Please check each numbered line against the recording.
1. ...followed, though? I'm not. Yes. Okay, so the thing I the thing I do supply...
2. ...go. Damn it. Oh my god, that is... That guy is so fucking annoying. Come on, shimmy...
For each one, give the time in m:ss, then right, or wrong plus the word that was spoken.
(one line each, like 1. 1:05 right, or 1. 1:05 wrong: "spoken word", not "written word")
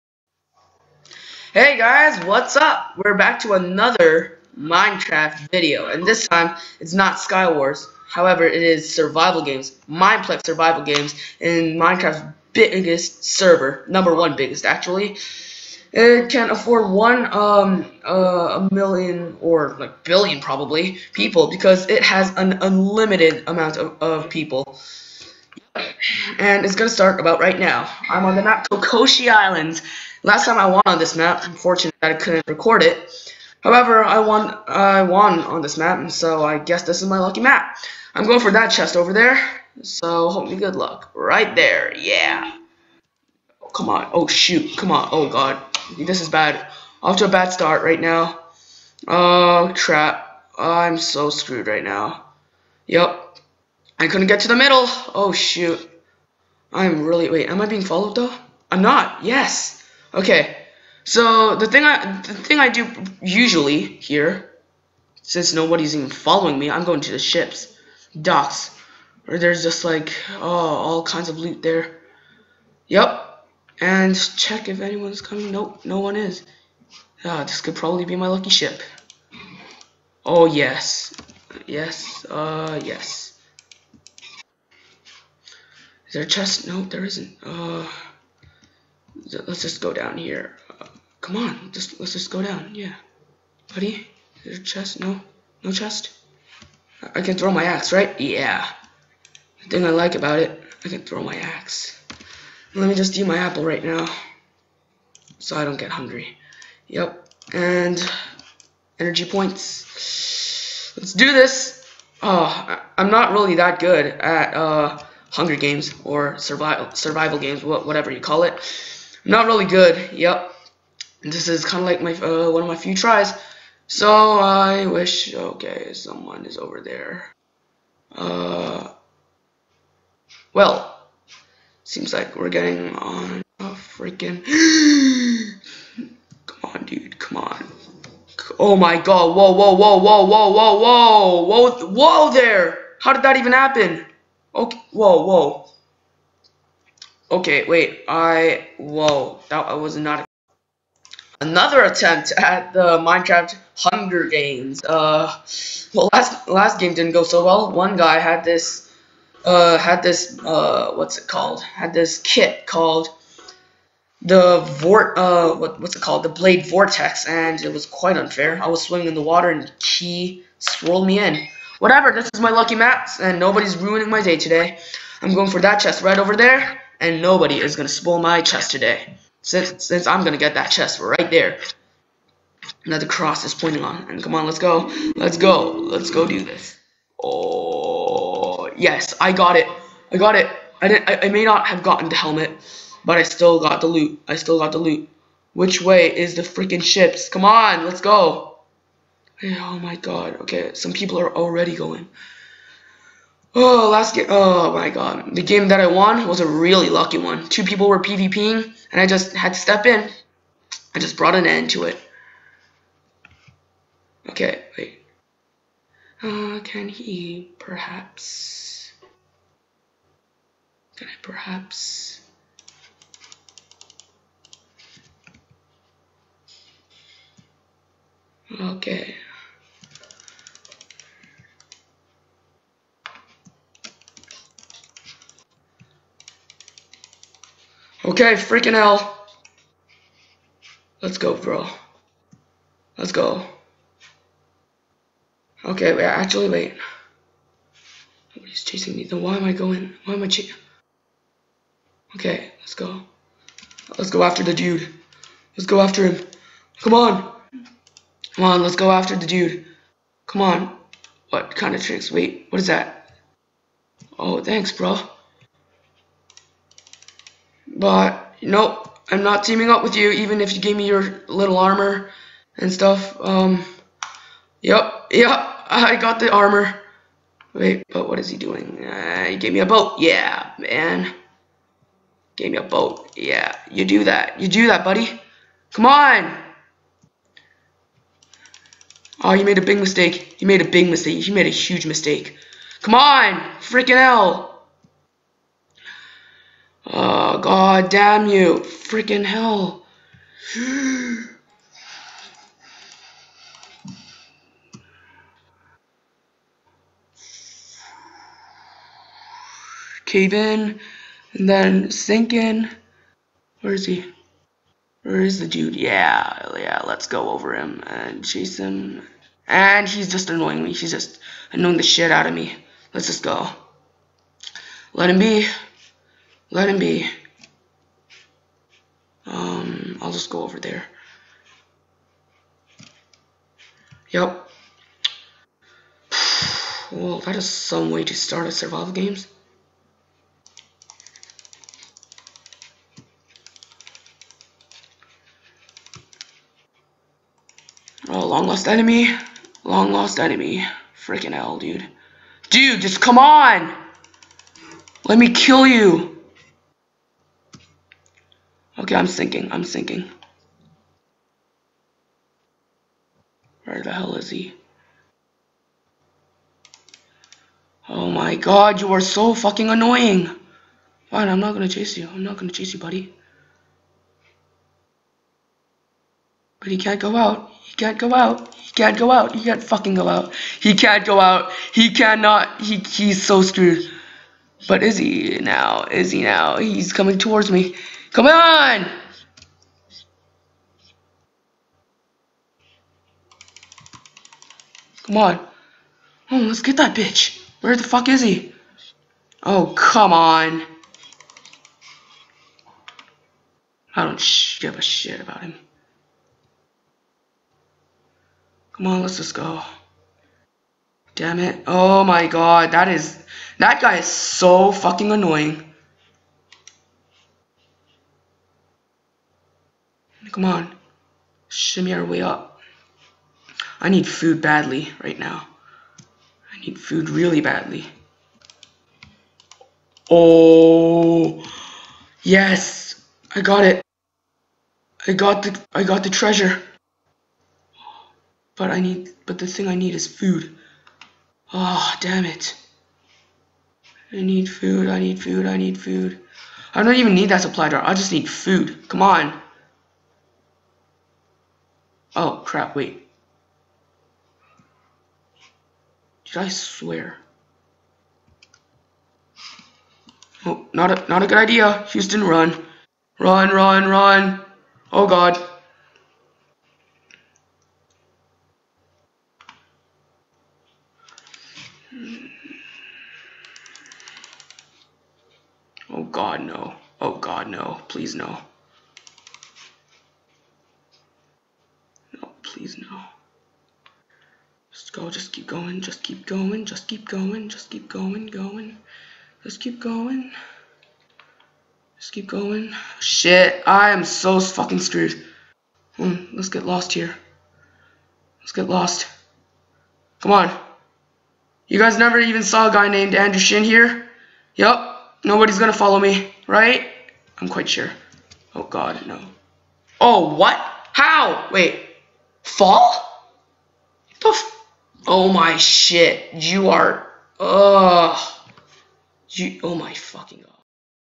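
1. 0:57 wrong: "usually", not "supply"
2. 6:49 right.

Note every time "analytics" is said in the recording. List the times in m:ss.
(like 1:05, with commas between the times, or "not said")
not said.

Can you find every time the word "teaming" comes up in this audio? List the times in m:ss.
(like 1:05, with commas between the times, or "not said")
4:29.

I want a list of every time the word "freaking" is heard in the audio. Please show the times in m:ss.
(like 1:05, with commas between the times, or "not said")
2:13, 3:16, 3:58, 4:53, 4:58, 5:51.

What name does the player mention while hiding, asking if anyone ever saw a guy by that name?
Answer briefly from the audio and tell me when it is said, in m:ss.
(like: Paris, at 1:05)
Andrew Shin, at 8:23.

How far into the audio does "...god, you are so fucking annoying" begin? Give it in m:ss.
6:08.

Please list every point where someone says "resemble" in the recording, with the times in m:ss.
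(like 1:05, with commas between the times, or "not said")
not said.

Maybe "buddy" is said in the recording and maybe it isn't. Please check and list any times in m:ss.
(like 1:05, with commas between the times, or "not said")
1:33, 4:44, 6:12.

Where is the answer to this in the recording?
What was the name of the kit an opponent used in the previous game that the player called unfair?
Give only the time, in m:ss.
2:46.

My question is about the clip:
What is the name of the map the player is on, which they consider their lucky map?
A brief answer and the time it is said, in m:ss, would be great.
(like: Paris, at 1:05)
Kokoshi Islands, at 0:28.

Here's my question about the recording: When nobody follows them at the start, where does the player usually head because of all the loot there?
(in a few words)
the ships docks.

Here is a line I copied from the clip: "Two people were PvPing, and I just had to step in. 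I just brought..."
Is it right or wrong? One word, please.
right.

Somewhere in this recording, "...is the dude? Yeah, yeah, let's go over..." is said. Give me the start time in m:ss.
5:15.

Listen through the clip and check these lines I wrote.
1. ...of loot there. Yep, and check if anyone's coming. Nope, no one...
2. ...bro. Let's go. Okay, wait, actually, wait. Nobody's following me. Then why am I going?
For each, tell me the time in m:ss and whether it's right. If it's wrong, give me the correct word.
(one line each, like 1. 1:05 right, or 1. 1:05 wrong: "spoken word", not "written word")
1. 1:11 right
2. 4:01 wrong: "chasing", not "following".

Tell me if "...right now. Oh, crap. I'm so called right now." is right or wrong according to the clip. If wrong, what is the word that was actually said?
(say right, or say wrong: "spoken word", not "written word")
wrong: "screwed", not "called".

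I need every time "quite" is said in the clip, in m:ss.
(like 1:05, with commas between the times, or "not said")
2:47, 8:27.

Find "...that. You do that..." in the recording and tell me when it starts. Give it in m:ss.
4:44.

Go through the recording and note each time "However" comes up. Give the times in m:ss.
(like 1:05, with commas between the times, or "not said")
0:08, 0:33.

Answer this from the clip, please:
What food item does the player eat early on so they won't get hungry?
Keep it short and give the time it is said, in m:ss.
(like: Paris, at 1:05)
apple, at 1:43.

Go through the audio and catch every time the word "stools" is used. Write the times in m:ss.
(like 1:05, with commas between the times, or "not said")
not said.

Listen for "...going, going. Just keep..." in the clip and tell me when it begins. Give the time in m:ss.
8:07.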